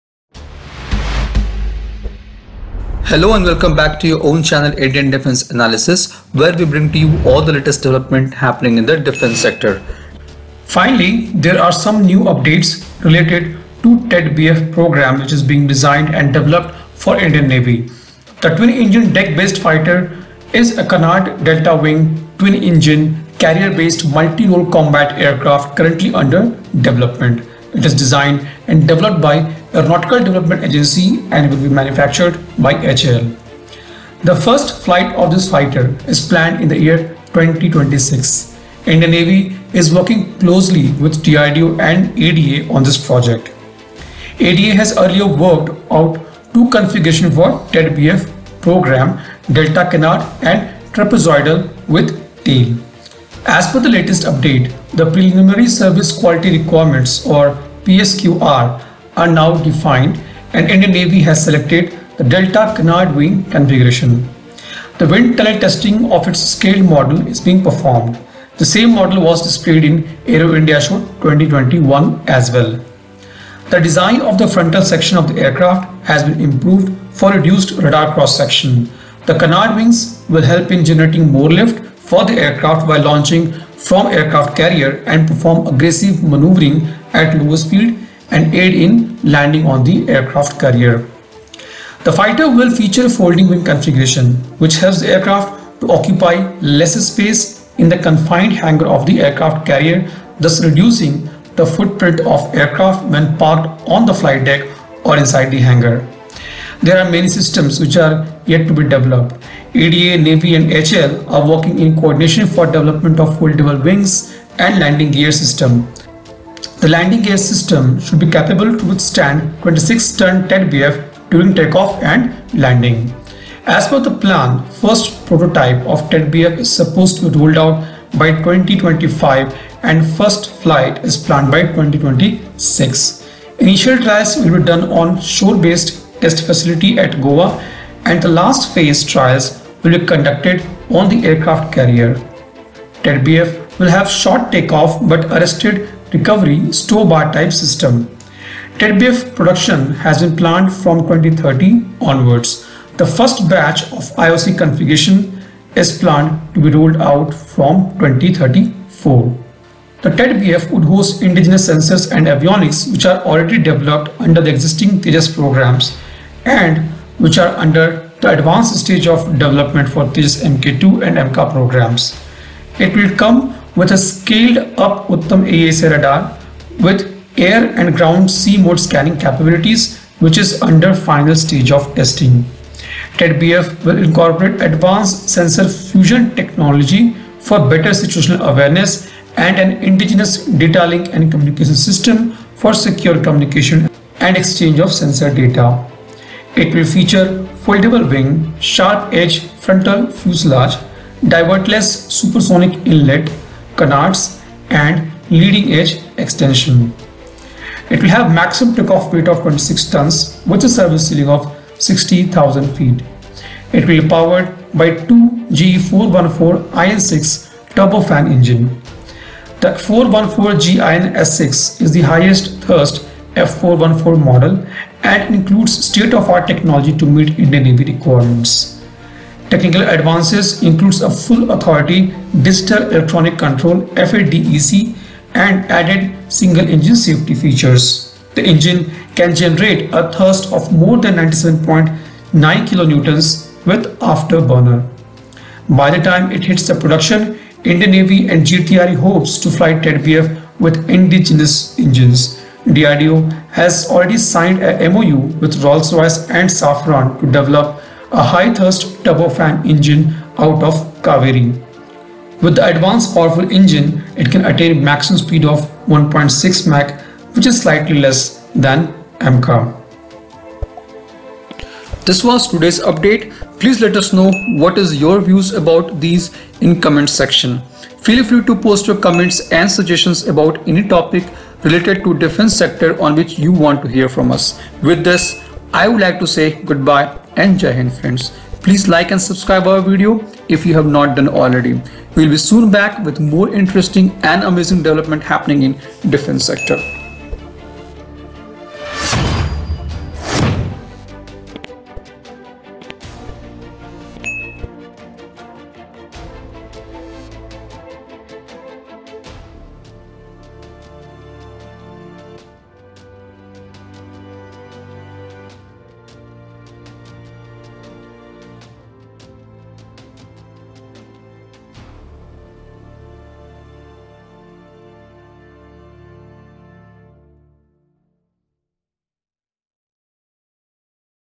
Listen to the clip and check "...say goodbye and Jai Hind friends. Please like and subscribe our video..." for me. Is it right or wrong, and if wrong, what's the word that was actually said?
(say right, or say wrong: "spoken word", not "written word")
right.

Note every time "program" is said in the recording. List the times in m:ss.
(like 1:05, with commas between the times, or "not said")
0:14, 0:48, 2:45, 2:51.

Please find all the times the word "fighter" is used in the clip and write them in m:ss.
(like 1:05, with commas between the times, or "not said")
0:19, 0:35, 1:32.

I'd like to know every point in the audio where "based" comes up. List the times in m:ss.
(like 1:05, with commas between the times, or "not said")
0:19, 0:23, 2:15.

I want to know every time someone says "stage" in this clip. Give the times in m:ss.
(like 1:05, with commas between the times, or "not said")
2:48, 3:01.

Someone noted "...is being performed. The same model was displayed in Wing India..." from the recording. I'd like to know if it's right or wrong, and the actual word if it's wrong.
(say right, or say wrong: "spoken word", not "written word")
wrong: "Aero", not "Wing".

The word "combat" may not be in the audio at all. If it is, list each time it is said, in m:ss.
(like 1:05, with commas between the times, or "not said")
0:24.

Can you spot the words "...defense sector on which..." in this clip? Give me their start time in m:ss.
4:42.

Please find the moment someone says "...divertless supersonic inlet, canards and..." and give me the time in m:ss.
3:21.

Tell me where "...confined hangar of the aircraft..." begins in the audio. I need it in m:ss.
1:37.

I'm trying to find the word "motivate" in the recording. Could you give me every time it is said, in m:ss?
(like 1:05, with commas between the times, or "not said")
not said.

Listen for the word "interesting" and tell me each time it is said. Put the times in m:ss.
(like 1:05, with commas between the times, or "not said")
4:53.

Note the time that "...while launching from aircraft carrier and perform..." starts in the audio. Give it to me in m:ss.
1:22.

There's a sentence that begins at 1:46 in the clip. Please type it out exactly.
There are many systems which are yet to be developed.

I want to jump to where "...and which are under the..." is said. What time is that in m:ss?
2:46.